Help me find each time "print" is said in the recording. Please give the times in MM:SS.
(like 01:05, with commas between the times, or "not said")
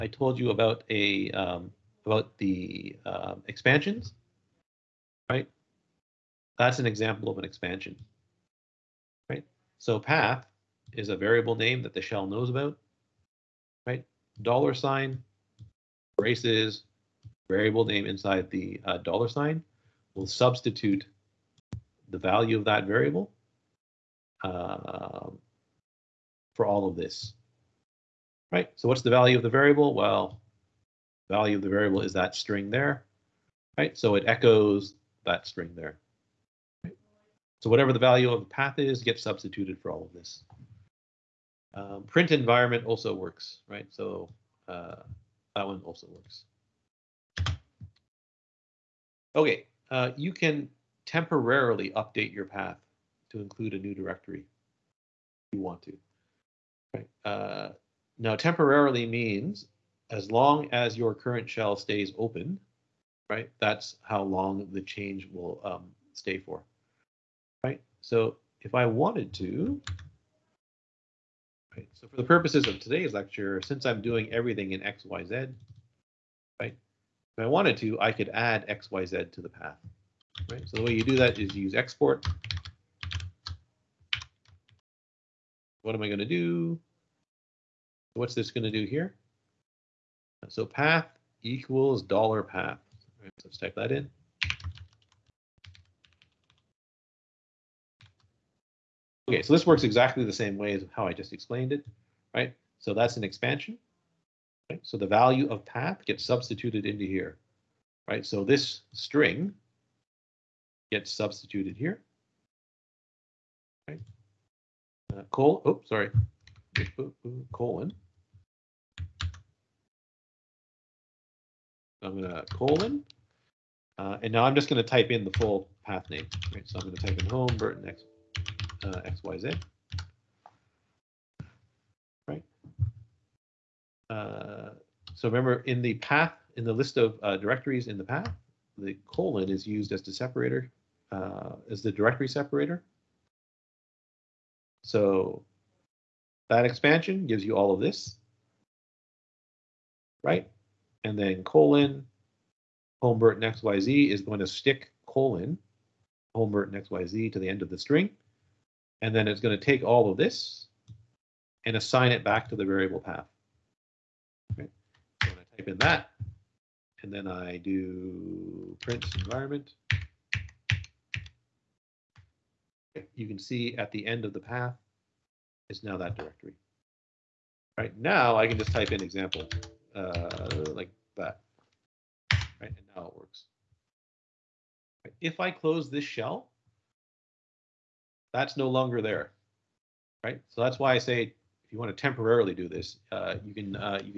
00:42, 02:48.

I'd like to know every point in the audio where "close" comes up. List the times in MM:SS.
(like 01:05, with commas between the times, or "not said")
03:05.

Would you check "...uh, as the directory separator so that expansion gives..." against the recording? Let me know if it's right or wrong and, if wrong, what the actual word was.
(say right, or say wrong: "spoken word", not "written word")
right.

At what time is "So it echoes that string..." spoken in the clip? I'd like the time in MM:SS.
00:33.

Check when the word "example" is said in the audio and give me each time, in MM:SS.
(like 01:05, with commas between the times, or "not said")
00:06, 02:59.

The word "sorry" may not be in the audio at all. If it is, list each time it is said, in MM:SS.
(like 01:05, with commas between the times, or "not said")
01:55.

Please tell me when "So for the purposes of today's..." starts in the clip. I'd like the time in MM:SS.
01:11.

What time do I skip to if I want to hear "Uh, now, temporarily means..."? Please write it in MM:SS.
00:57.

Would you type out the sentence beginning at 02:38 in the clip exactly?
And then it's going to take all of this and assign it back to the variable path.